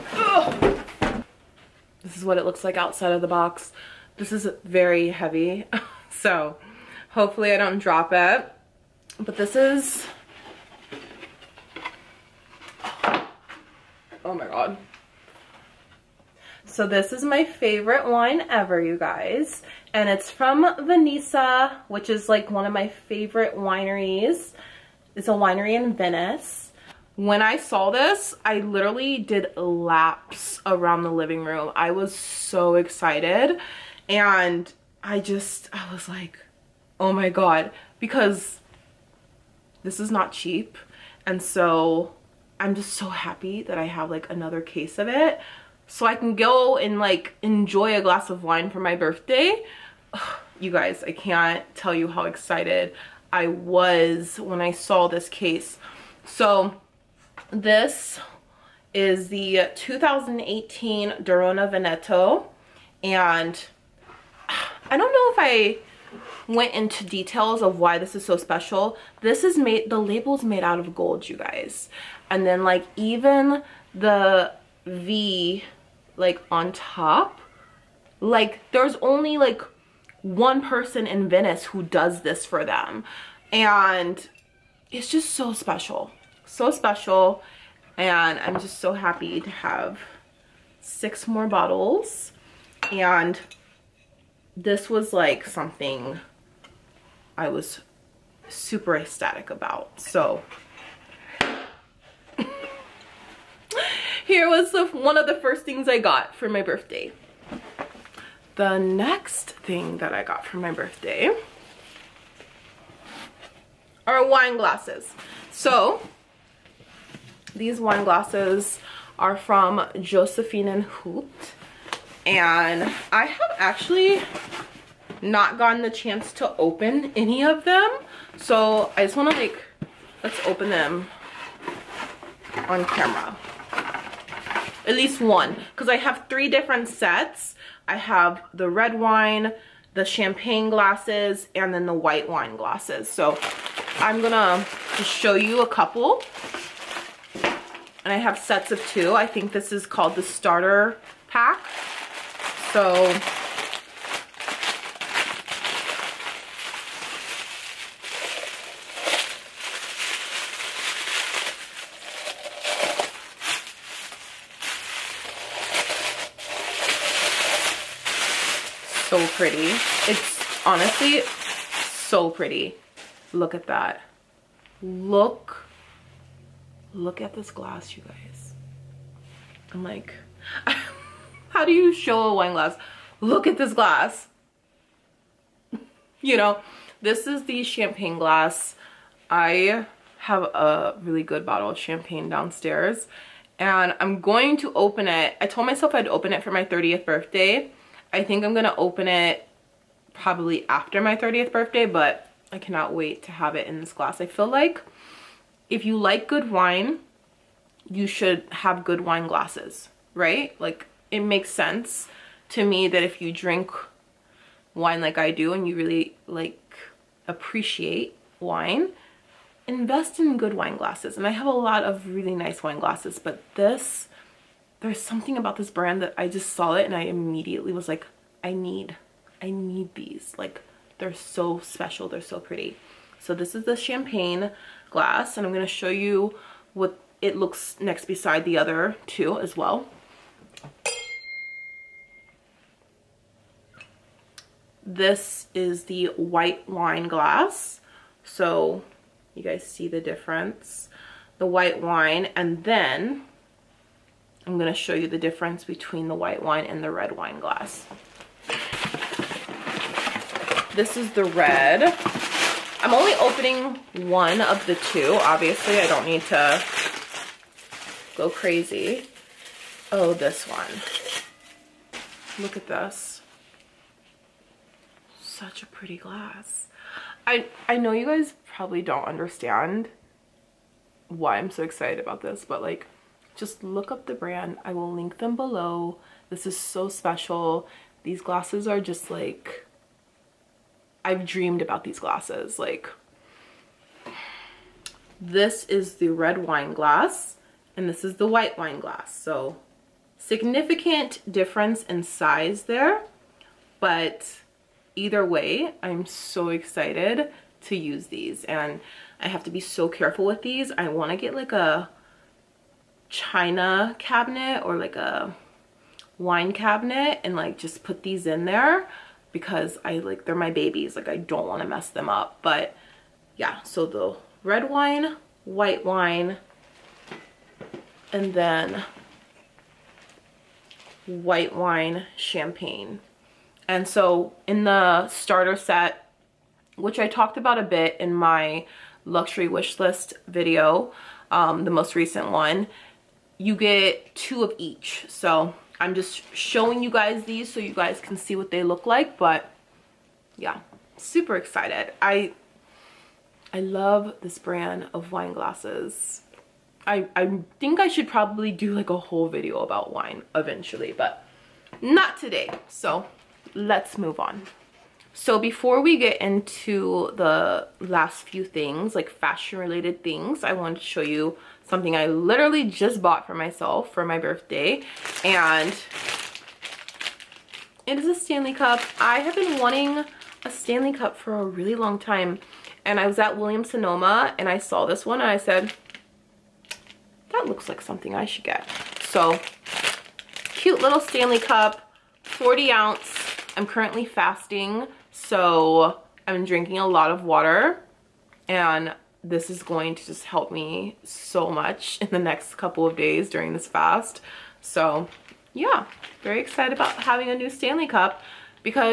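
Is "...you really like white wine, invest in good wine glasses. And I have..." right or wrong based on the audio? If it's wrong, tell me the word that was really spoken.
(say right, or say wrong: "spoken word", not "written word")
wrong: "appreciate", not "white".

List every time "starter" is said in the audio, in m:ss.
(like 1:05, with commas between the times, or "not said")
2:30, 5:35.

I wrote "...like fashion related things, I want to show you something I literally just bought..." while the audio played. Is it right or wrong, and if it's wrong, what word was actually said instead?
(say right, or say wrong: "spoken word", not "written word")
right.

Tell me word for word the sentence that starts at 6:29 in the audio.
So cute little Stanley Cup, 40 ounce.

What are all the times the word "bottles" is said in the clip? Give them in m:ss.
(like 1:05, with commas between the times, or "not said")
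1:31, 3:11.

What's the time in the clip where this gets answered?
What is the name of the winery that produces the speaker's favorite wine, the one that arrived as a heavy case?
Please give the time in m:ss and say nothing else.
0:20.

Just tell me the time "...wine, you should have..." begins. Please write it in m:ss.
3:26.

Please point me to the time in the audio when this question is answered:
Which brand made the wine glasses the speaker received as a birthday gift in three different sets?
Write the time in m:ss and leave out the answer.
1:59.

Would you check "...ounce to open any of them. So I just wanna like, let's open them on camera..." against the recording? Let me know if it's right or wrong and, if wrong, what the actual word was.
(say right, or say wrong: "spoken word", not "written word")
wrong: "chance", not "ounce".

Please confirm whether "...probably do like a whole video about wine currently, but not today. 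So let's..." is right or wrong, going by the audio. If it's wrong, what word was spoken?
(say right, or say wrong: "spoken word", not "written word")
wrong: "eventually", not "currently".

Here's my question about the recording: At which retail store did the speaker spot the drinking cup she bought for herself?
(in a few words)
Williams Sonoma.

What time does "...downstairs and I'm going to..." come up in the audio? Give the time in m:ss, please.
3:12.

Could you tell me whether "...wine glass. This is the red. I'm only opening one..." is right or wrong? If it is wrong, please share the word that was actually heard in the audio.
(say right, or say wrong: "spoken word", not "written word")
right.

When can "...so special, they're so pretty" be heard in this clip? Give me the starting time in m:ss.
3:51.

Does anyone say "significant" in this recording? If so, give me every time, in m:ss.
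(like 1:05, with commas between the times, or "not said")
5:00.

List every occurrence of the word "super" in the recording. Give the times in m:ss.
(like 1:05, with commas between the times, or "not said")
1:38, 5:50.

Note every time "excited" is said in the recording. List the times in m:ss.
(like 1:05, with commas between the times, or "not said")
0:32, 0:52, 4:41, 5:06, 5:51, 6:46.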